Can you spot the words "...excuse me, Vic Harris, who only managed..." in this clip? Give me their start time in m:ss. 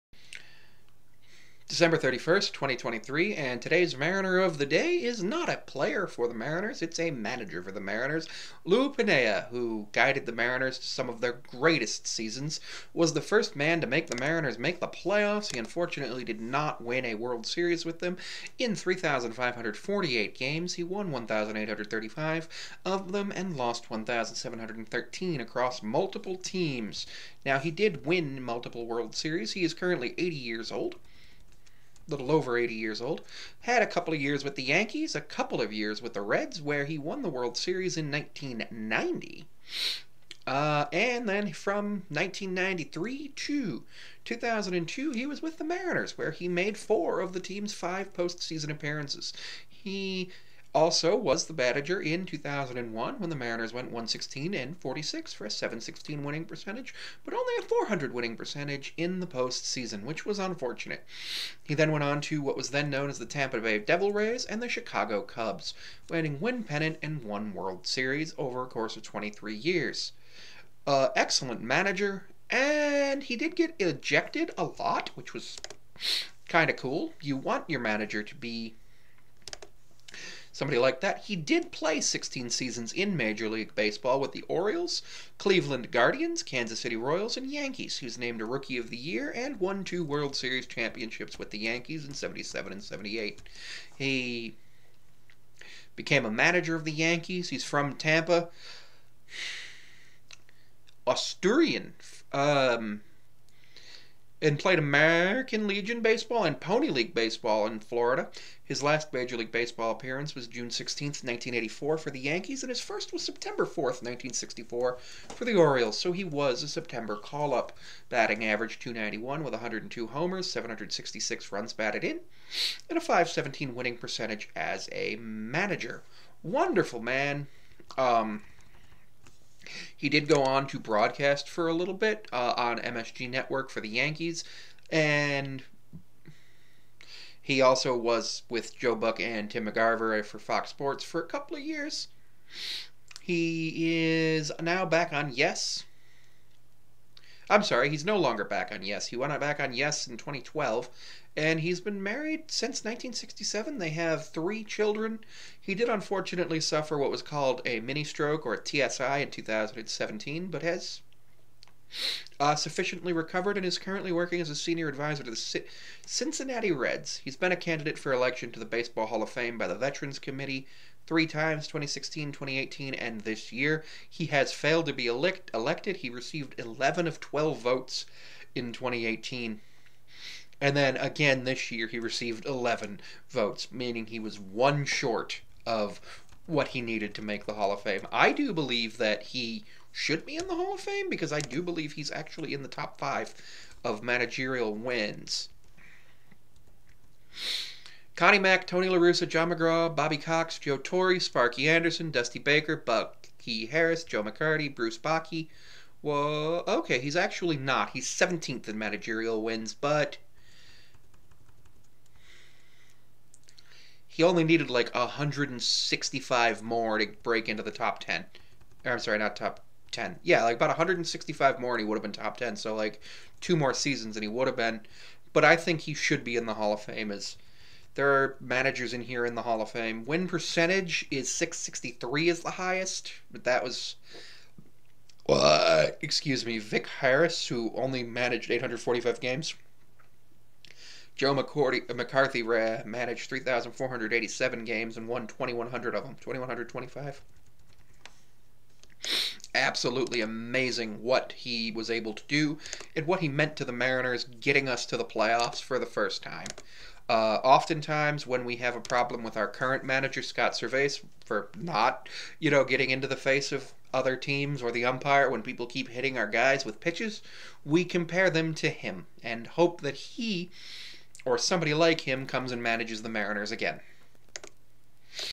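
3:55.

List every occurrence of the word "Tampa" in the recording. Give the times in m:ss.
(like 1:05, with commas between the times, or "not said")
1:03, 1:37.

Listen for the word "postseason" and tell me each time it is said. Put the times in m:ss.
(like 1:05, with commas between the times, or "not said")
0:48, 0:59.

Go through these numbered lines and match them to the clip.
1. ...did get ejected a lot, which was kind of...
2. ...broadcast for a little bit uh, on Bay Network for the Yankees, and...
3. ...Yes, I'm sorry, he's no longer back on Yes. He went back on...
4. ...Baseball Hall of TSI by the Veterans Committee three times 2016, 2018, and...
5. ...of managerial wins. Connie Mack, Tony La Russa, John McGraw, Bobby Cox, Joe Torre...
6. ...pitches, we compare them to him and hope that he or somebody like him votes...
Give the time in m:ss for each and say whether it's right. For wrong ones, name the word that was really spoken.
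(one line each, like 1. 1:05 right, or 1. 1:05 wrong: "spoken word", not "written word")
1. 1:13 right
2. 2:10 wrong: "MSG", not "Bay"
3. 2:25 right
4. 2:48 wrong: "Fame", not "TSI"
5. 3:13 right
6. 4:26 wrong: "comes", not "votes".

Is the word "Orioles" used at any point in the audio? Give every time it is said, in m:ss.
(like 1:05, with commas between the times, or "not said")
1:24, 1:55.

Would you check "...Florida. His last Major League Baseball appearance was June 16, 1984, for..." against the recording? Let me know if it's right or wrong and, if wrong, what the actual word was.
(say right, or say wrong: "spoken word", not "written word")
right.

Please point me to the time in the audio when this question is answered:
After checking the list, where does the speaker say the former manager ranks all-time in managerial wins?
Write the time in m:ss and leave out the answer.
3:28.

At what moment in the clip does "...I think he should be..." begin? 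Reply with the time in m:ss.
3:45.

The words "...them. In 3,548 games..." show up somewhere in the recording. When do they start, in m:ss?
0:17.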